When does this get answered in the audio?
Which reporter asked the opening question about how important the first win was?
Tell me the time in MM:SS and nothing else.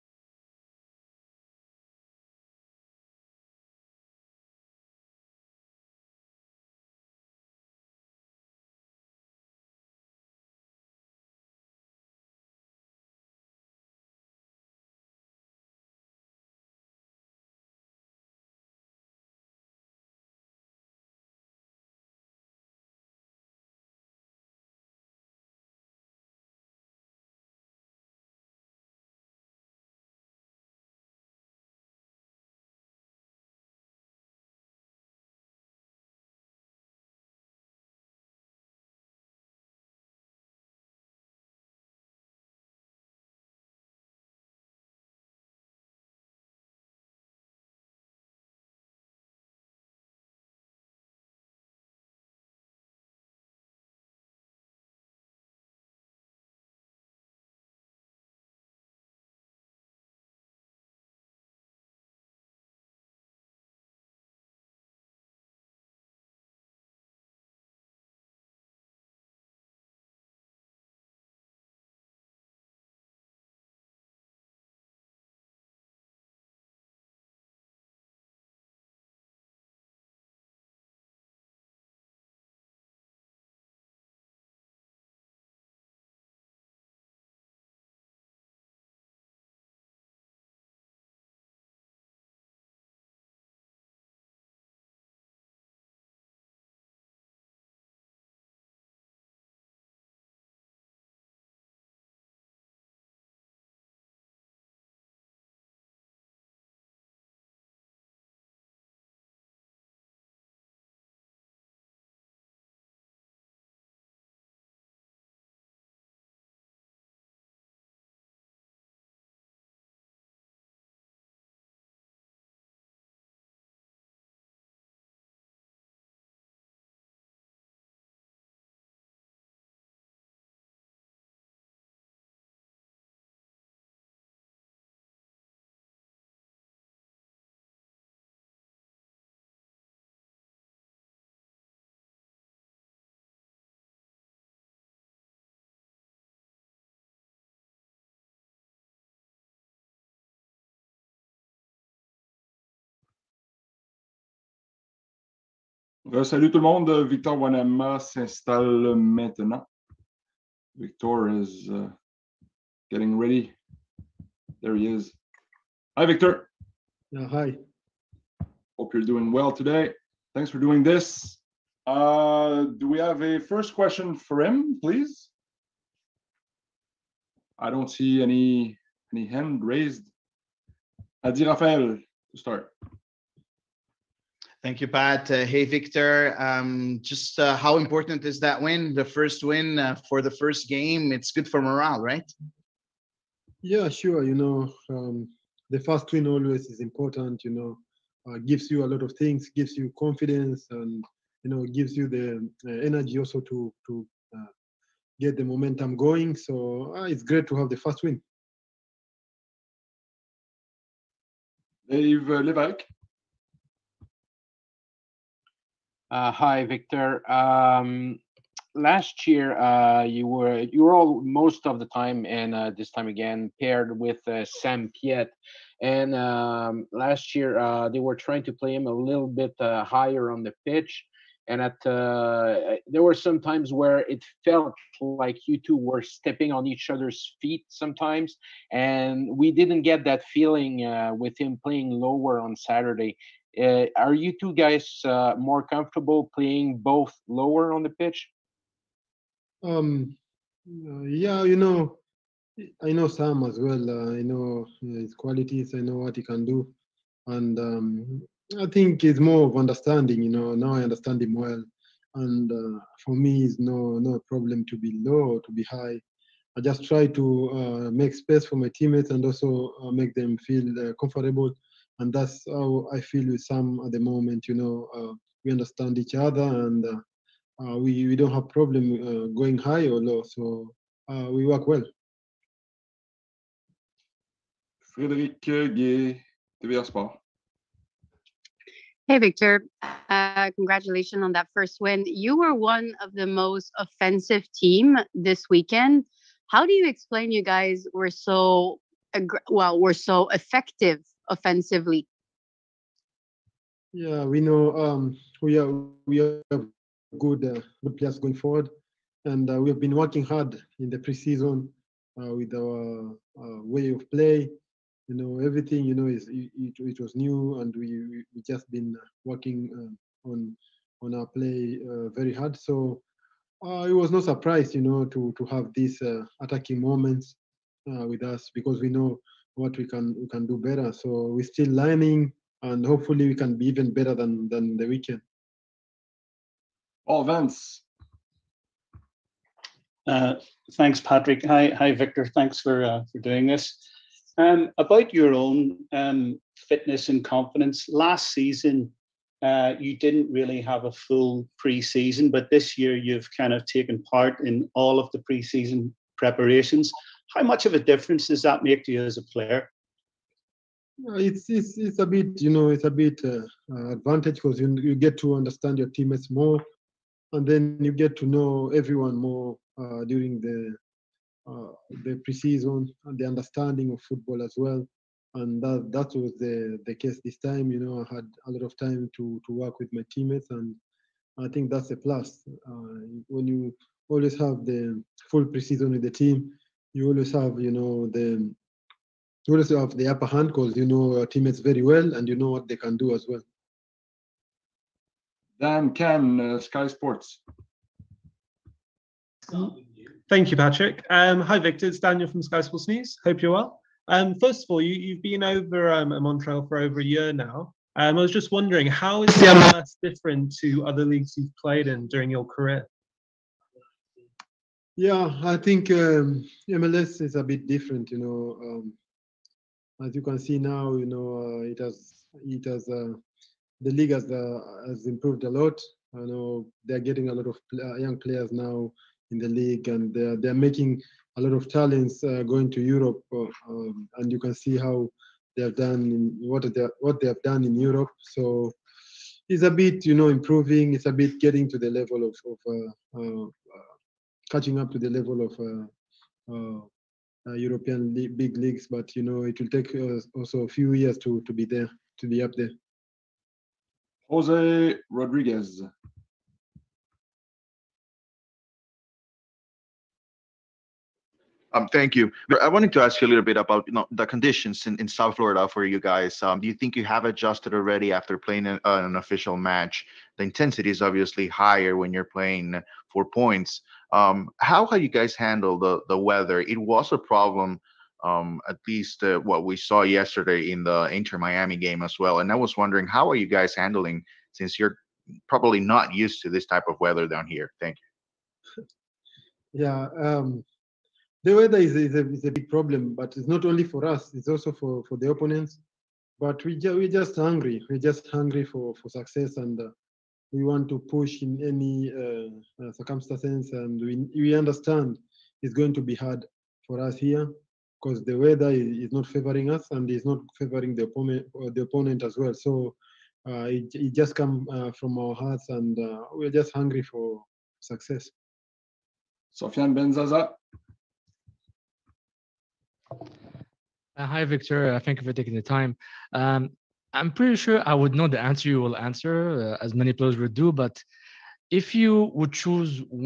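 03:01.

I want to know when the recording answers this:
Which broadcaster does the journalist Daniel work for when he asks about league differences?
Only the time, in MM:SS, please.
06:42.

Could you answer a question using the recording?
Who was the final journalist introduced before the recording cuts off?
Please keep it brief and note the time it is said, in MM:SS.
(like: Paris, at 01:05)
Sofian Benzaza, at 08:39.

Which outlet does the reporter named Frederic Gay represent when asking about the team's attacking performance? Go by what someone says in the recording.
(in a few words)
Sport.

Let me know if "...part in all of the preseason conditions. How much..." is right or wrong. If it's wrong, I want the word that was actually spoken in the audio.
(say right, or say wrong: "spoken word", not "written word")
wrong: "preparations", not "conditions".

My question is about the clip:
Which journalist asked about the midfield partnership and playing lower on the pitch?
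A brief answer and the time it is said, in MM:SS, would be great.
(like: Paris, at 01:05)
Dave Levac, at 03:31.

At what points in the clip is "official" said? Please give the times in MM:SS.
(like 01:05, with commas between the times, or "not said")
07:49.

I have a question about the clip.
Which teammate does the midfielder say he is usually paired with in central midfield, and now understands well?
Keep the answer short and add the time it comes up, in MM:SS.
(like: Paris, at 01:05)
Sam Piette, at 03:44.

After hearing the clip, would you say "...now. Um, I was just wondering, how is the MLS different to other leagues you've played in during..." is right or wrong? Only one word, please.
right.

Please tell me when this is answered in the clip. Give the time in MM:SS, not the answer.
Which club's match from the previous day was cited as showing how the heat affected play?
08:01.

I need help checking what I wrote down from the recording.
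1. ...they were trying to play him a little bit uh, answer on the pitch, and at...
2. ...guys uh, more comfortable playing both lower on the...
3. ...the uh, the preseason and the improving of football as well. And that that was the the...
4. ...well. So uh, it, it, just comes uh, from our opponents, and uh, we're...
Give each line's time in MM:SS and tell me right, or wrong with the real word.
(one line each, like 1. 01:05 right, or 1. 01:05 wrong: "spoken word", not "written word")
1. 03:47 wrong: "higher", not "answer"
2. 04:04 right
3. 06:10 wrong: "understanding", not "improving"
4. 08:32 wrong: "hearts", not "opponents".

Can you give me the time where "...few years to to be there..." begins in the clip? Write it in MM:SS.
07:30.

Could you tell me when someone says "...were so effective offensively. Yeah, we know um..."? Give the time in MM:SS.
04:59.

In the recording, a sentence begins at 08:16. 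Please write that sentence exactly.
But we ju- we're just hungry.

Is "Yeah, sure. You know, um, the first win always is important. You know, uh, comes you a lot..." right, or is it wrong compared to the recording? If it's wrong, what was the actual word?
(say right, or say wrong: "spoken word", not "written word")
wrong: "gives", not "comes".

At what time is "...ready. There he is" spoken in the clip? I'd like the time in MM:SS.
02:43.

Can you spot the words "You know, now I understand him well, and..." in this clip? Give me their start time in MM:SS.
04:20.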